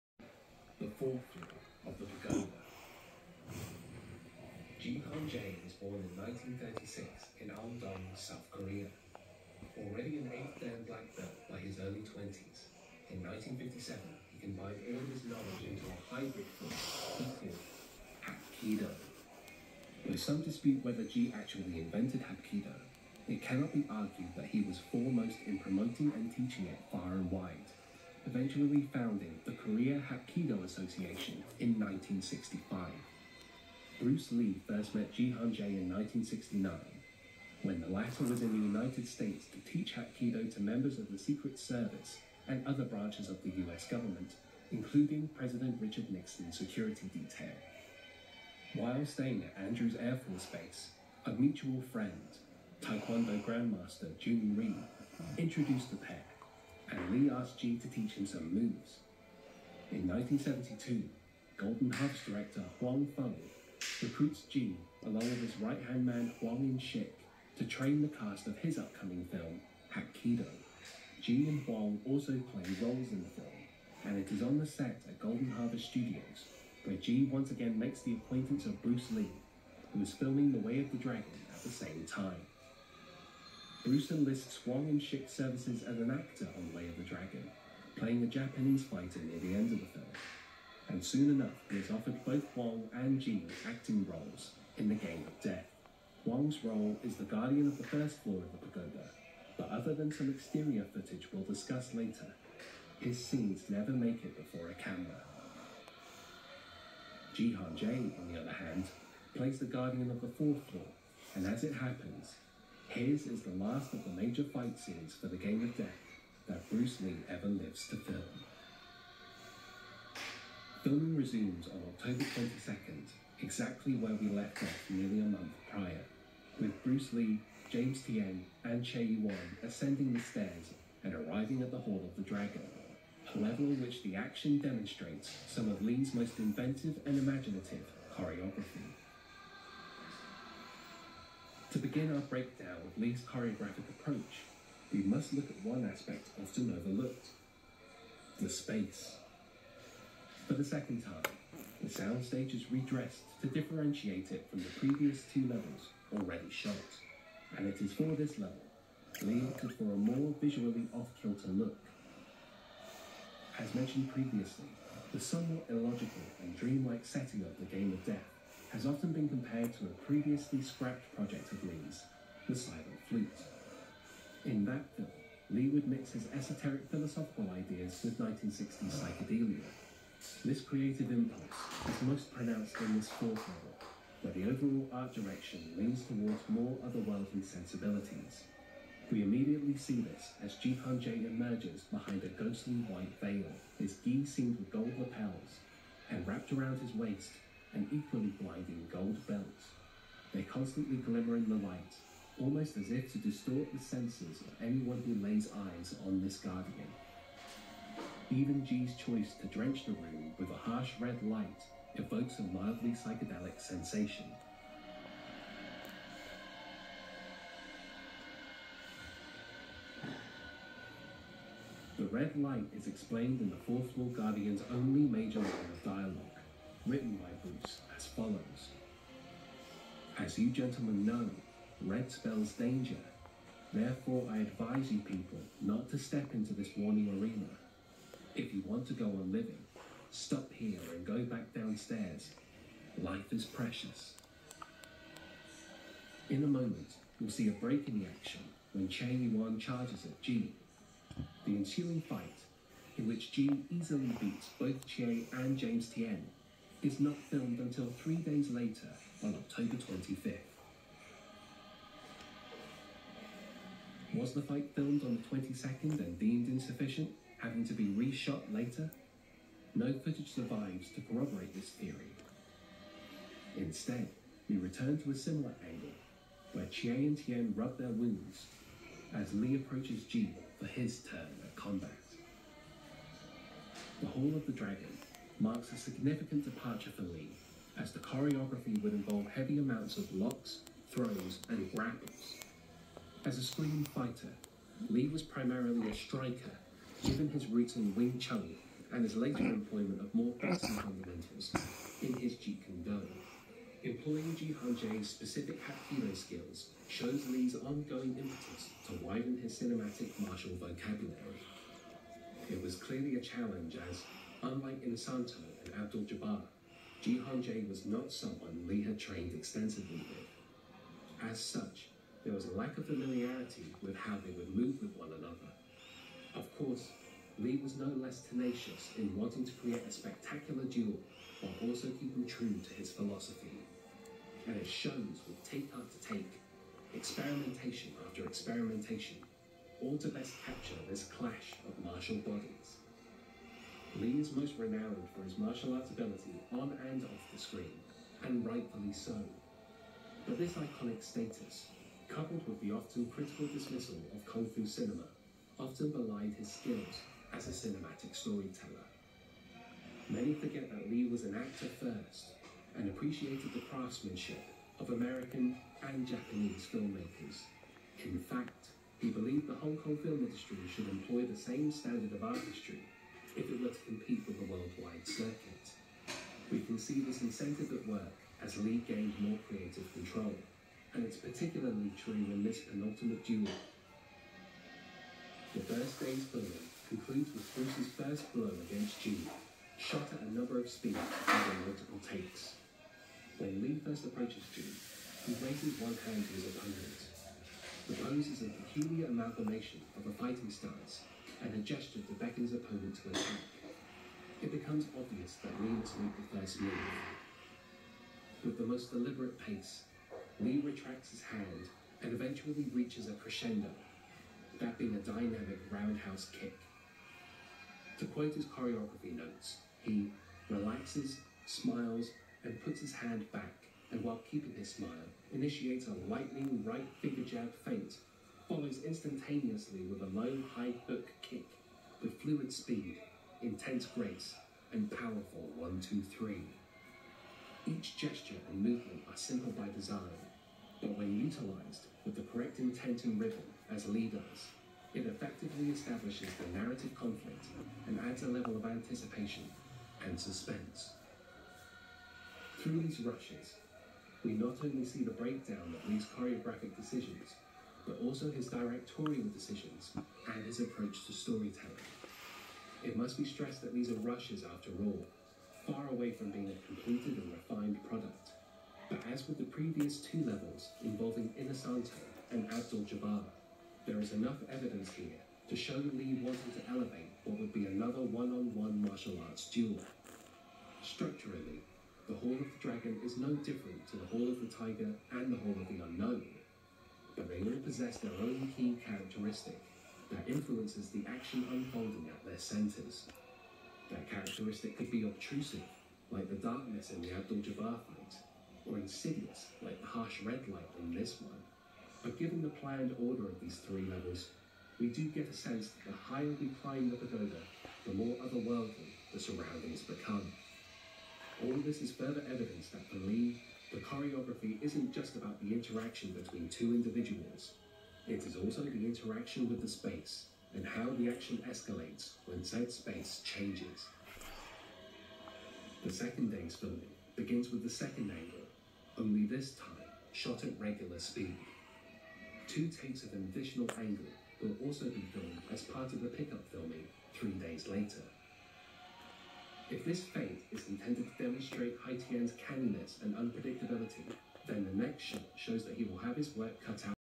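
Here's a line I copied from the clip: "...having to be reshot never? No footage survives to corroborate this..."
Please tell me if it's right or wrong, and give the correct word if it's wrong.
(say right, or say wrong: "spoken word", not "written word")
wrong: "later", not "never".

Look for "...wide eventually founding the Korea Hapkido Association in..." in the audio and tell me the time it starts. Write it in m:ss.
0:27.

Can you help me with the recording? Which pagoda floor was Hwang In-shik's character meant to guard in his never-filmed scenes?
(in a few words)
first floor.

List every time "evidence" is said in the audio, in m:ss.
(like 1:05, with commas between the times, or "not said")
7:54, 8:32.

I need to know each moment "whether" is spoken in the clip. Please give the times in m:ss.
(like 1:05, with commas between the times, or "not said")
0:20.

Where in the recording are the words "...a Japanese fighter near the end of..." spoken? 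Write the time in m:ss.
1:28.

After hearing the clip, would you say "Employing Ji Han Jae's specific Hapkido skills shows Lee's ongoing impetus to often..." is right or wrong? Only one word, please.
wrong.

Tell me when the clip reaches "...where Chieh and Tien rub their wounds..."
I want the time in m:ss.
4:36.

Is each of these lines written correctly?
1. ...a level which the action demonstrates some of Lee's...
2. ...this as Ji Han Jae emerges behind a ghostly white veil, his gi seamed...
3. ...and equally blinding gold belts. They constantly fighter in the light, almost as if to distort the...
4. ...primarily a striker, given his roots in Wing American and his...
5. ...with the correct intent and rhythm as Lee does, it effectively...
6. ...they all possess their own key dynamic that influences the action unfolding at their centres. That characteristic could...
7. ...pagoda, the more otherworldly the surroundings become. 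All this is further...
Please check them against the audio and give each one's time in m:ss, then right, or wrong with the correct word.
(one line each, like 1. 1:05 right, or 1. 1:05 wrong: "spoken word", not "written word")
1. 2:13 right
2. 3:09 right
3. 3:17 wrong: "glimmer", not "fighter"
4. 4:55 wrong: "Chun", not "American"
5. 7:22 right
6. 8:07 wrong: "characteristic", not "dynamic"
7. 8:26 right.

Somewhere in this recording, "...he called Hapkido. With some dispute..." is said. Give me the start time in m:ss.
0:16.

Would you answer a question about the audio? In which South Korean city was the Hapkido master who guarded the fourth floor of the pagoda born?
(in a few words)
Andong.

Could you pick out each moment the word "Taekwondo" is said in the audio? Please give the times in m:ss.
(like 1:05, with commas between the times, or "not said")
0:52.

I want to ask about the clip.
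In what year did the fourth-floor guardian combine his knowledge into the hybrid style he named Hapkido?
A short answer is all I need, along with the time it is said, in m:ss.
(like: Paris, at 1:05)
1957, at 0:13.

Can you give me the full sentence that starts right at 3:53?
Therefore, I advise you people not to step into this warning arena.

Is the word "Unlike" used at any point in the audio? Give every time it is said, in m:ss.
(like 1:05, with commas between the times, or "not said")
5:14.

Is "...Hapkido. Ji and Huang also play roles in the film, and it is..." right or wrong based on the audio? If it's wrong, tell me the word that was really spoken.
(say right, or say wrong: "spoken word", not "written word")
right.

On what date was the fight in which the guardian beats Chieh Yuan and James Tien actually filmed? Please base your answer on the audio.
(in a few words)
October 25.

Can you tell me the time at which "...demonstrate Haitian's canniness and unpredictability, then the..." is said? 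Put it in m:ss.
9:01.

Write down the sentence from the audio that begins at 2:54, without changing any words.
In that film, Lee would mix his esoteric philosophical ideas with 1960s psychedelia.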